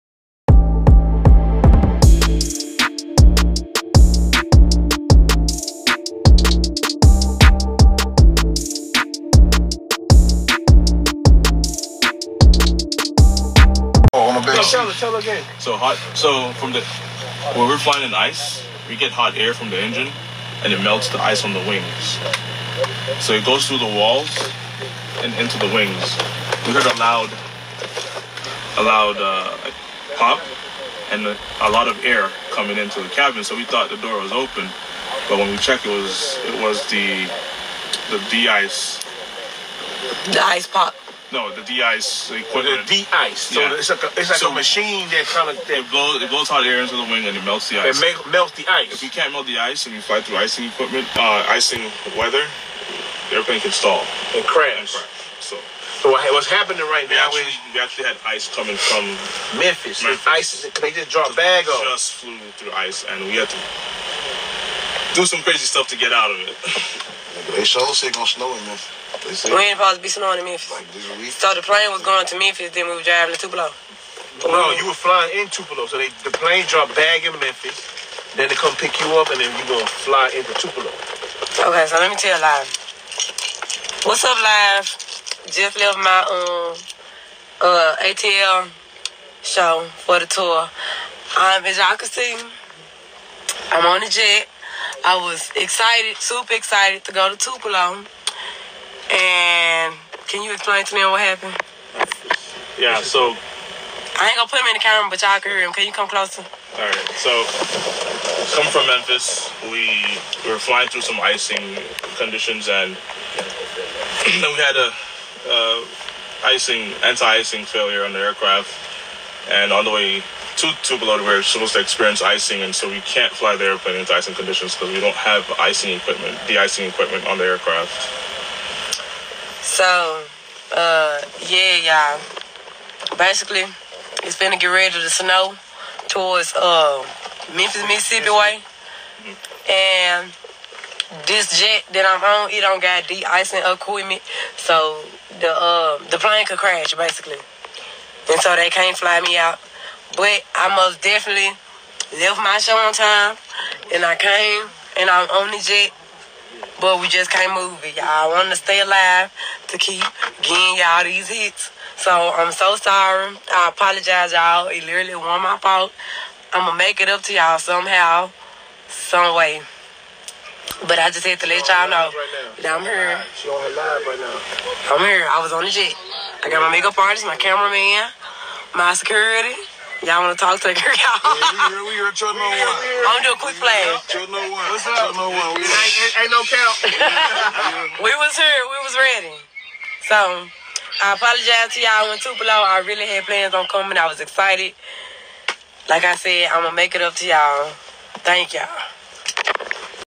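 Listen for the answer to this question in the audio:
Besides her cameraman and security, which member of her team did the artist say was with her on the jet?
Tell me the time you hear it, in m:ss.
2:56.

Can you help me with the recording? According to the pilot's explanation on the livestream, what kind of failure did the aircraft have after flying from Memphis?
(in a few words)
Anti-icing failure.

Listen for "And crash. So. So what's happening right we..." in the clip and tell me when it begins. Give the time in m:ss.
0:54.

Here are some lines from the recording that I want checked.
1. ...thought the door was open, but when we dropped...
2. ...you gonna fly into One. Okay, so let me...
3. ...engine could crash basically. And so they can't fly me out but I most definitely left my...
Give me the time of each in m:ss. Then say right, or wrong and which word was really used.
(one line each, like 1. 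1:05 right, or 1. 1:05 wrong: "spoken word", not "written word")
1. 0:33 wrong: "checked", not "dropped"
2. 1:19 wrong: "Tupelo", not "One"
3. 2:26 wrong: "plane", not "engine".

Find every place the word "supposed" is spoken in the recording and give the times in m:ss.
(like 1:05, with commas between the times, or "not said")
1:09, 2:01.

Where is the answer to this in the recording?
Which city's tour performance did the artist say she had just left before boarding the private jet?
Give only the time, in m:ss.
1:28.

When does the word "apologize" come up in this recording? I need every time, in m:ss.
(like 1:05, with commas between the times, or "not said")
2:43, 3:11.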